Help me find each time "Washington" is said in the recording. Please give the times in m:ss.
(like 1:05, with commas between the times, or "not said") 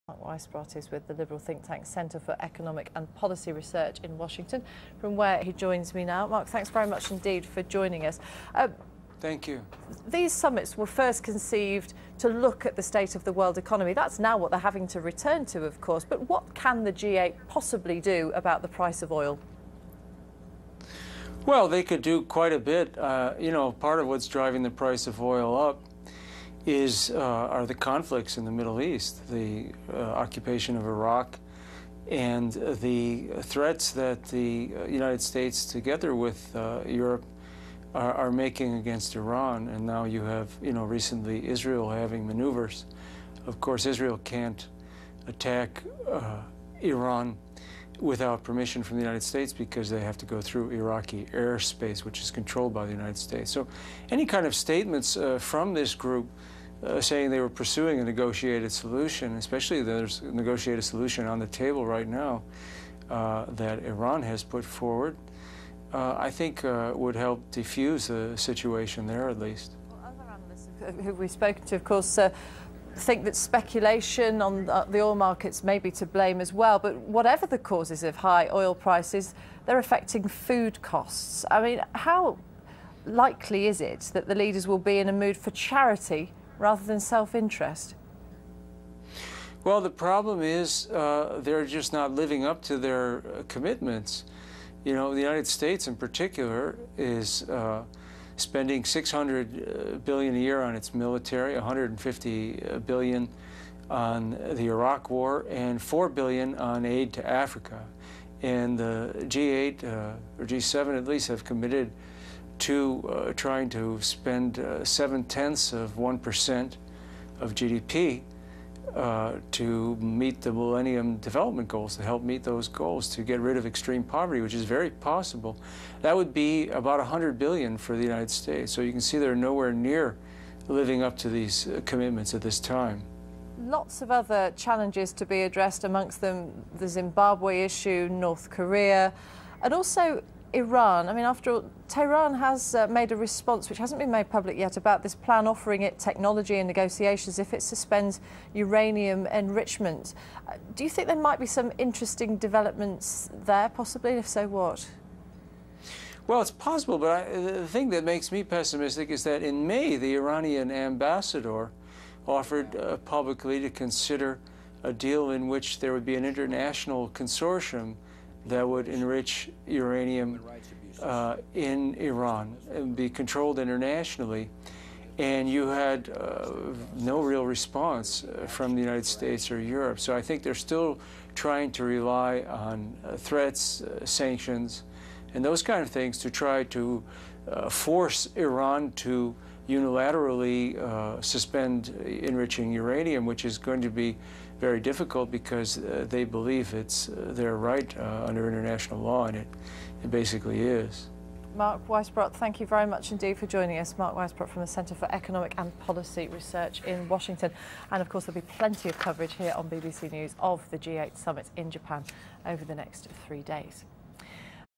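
0:04, 3:27.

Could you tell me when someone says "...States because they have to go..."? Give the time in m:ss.
0:49.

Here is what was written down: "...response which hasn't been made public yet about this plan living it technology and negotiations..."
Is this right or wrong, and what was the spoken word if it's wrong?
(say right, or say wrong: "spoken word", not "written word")
wrong: "offering", not "living".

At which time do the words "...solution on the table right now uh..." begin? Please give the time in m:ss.
1:00.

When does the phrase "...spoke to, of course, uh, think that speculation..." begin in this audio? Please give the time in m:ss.
1:11.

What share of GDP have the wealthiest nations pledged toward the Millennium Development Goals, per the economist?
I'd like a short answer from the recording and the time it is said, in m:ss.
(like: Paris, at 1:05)
0.7 percent, at 1:54.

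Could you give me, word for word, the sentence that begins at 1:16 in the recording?
But whatever the causes of high oil prices, they're affecting food costs.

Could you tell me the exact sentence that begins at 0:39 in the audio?
And now you have, you know, recently Israel having maneuvers.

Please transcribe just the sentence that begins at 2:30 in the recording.
Uh, do you think there might be some interesting developments there, possibly?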